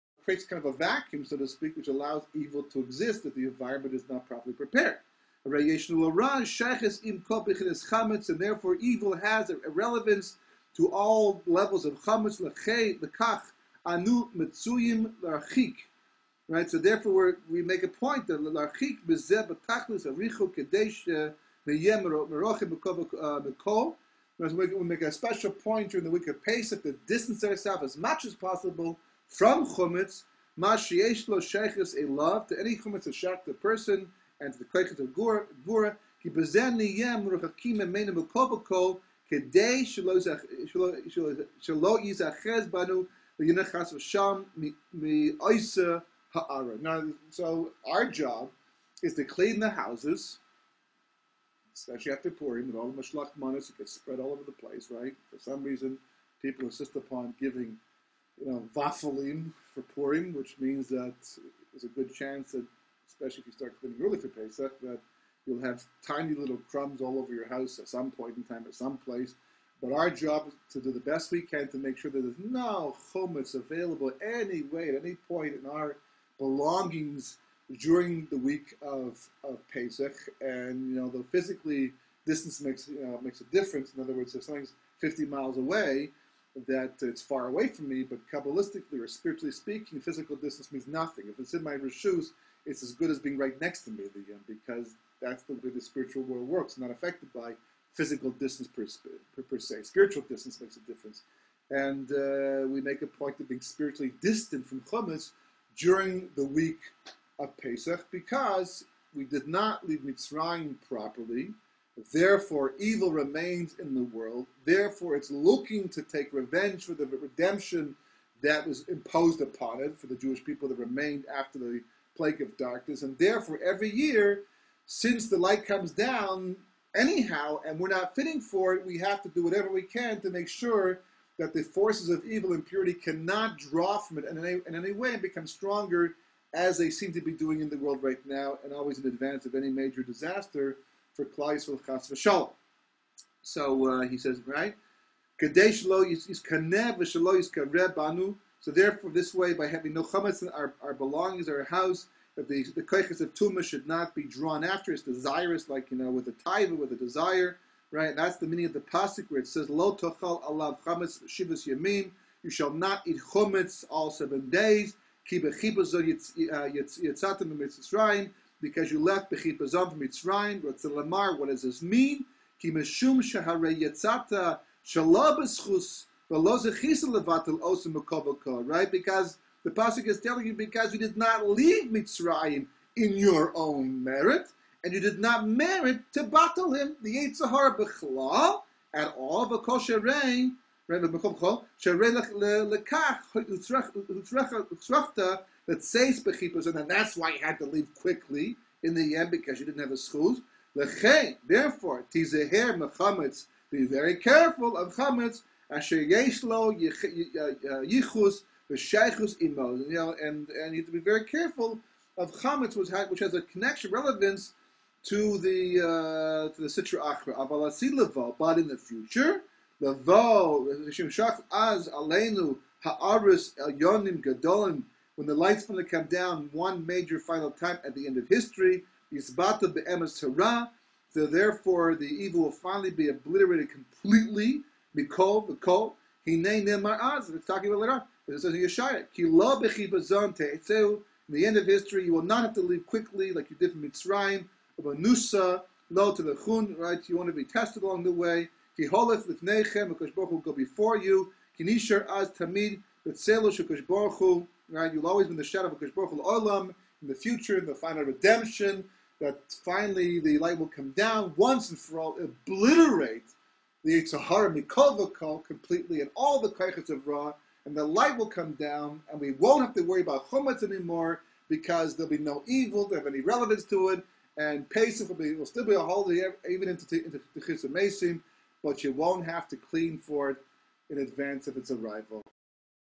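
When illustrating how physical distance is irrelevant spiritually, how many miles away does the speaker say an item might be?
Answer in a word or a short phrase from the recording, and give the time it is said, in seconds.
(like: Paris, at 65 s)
50, at 84 s.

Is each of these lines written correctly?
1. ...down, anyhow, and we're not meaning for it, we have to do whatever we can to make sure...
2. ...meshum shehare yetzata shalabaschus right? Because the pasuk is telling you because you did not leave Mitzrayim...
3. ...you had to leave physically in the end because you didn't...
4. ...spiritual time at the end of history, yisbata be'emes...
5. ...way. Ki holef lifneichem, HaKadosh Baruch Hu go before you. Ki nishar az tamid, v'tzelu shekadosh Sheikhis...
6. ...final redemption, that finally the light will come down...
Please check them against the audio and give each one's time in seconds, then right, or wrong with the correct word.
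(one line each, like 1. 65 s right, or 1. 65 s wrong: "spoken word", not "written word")
1. 125 s wrong: "fitting", not "meaning"
2. 172 s right
3. 197 s wrong: "quickly", not "physically"
4. 227 s wrong: "final", not "spiritual"
5. 248 s wrong: "Baruch", not "Sheikhis"
6. 257 s right.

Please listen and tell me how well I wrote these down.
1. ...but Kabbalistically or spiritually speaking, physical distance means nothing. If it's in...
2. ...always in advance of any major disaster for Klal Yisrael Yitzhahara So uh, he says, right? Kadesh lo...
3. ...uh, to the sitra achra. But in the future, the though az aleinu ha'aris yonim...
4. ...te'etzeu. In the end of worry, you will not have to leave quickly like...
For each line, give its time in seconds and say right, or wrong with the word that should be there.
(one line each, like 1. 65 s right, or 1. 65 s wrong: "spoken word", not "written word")
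1. 88 s right
2. 138 s wrong: "Chas", not "Yitzhahara"
3. 215 s right
4. 240 s wrong: "history", not "worry".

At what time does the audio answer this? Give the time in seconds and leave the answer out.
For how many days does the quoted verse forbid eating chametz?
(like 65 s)
161 s.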